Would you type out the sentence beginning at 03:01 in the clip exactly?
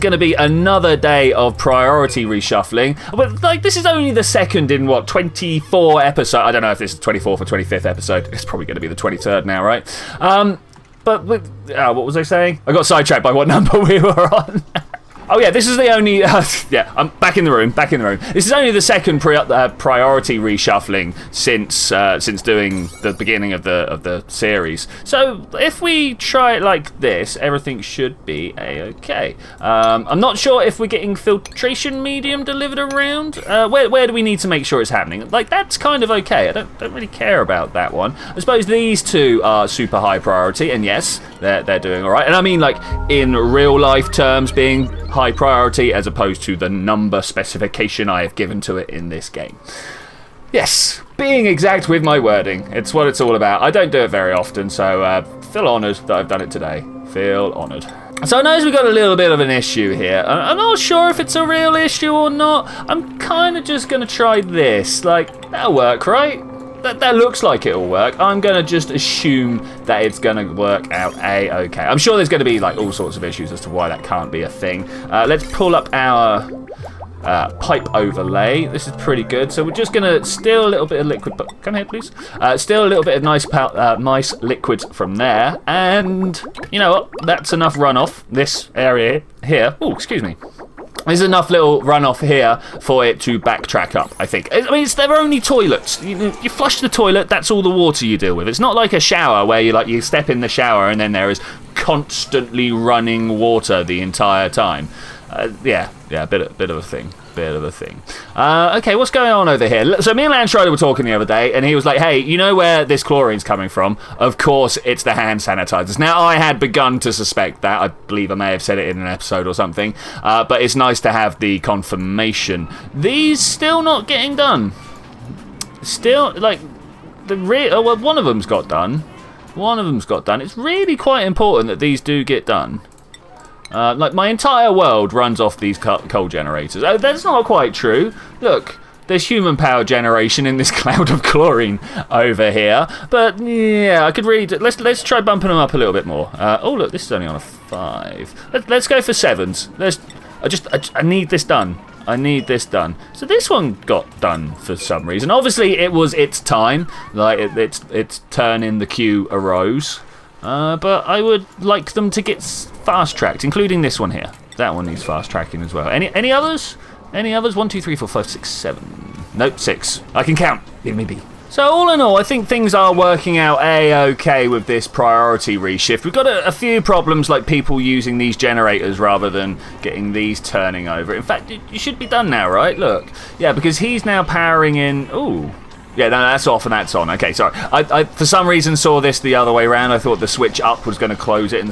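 In fact, you should be done now, right?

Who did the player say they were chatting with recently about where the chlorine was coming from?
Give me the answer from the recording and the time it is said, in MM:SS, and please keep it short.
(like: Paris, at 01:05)
Lance Schroeder, at 01:50.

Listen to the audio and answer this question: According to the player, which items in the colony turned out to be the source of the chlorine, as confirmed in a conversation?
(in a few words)
Hand sanitizers.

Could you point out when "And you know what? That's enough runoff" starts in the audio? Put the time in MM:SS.
01:25.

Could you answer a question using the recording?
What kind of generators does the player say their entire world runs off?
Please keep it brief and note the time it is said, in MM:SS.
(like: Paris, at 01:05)
Coal generators, at 02:15.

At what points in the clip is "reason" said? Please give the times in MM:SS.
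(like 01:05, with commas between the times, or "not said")
02:35, 03:08.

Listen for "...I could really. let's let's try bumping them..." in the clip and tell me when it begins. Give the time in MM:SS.
02:24.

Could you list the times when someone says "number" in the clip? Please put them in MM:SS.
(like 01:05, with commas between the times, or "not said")
00:13, 00:46.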